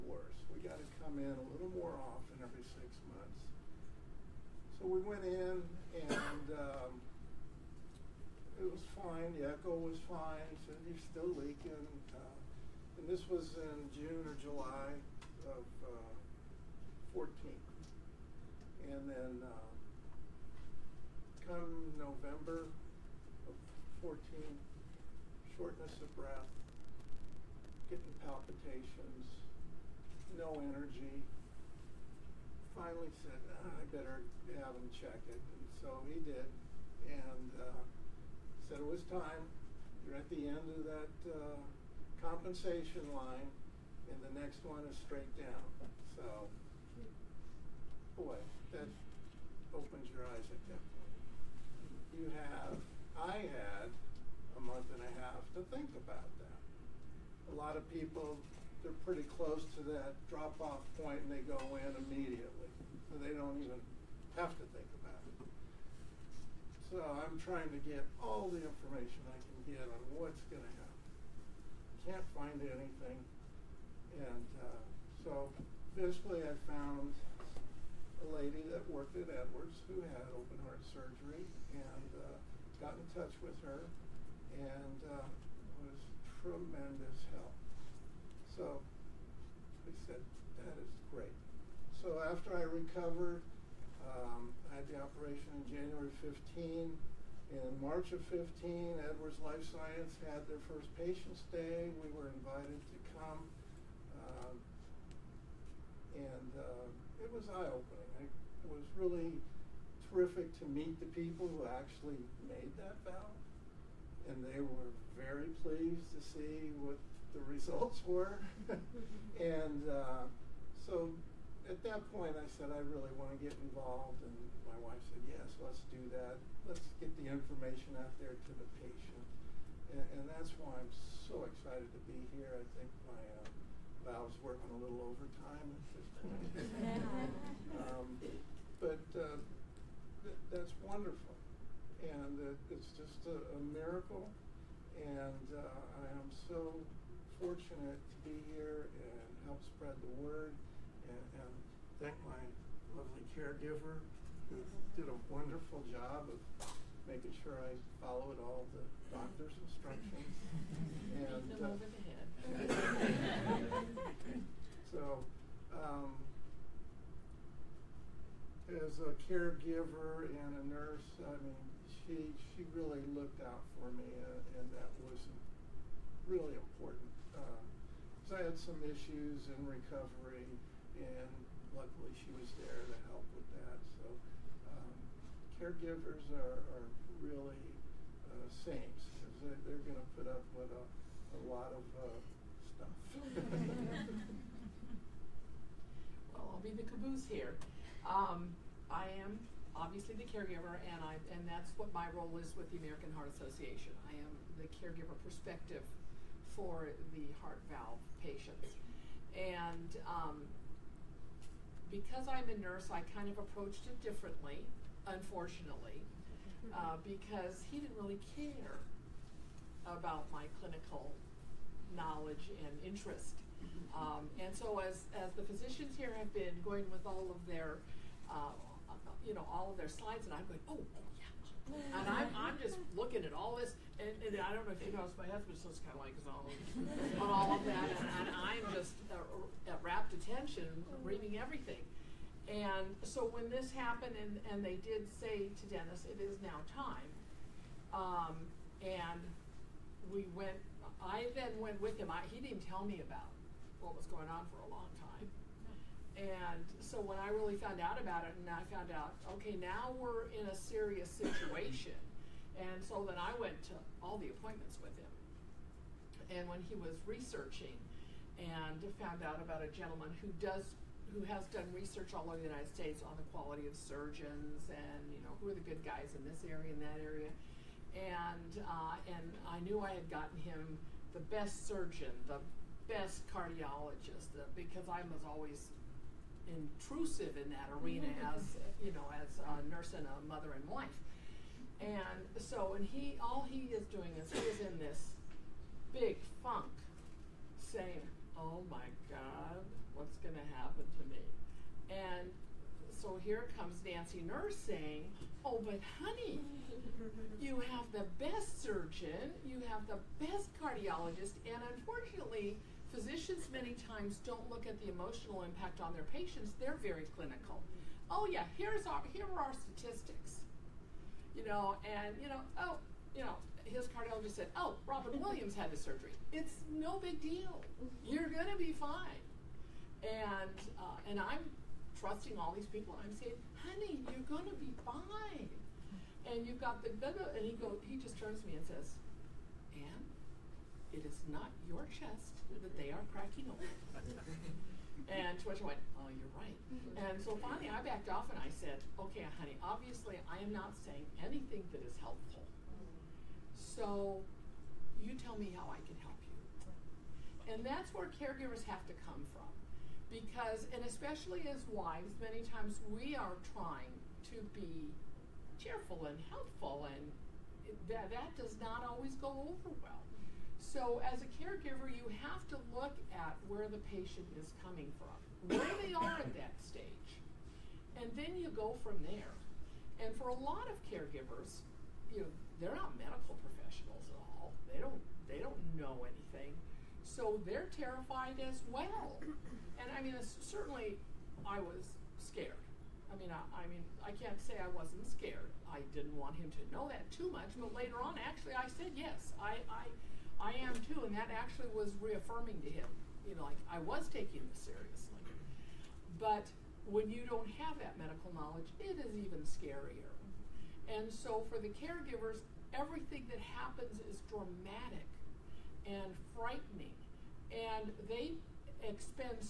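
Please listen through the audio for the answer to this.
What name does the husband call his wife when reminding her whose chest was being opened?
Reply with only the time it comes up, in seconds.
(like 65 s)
339 s.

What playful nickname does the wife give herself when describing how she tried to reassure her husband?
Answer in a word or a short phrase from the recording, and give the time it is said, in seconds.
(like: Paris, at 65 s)
Nancy Nurse, at 303 s.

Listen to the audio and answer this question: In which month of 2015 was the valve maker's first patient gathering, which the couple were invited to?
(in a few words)
March.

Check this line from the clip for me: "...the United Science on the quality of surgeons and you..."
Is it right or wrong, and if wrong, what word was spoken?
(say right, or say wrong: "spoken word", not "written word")
wrong: "States", not "Science".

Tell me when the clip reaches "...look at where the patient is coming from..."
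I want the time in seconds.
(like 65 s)
372 s.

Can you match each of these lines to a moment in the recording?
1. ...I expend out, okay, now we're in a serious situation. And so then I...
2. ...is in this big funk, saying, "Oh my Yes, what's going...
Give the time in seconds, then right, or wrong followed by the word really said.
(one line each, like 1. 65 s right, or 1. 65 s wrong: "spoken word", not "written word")
1. 258 s wrong: "found", not "expend"
2. 294 s wrong: "God", not "Yes".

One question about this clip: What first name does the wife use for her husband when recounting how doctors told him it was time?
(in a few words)
Dennis.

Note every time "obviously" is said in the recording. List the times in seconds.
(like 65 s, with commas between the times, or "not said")
199 s, 349 s.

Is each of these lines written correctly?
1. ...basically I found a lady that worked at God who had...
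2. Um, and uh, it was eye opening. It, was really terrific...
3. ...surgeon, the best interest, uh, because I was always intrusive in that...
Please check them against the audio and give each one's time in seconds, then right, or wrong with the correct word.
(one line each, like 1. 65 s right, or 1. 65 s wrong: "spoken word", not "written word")
1. 75 s wrong: "Edwards", not "God"
2. 104 s right
3. 281 s wrong: "cardiologist", not "interest".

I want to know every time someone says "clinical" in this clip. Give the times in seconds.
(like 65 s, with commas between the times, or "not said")
220 s, 317 s.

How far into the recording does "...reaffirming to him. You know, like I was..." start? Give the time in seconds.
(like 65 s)
402 s.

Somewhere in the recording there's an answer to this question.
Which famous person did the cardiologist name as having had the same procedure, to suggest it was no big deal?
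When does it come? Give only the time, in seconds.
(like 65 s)
324 s.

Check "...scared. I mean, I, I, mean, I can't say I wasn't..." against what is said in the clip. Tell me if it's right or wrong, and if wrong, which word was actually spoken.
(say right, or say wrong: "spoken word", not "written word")
right.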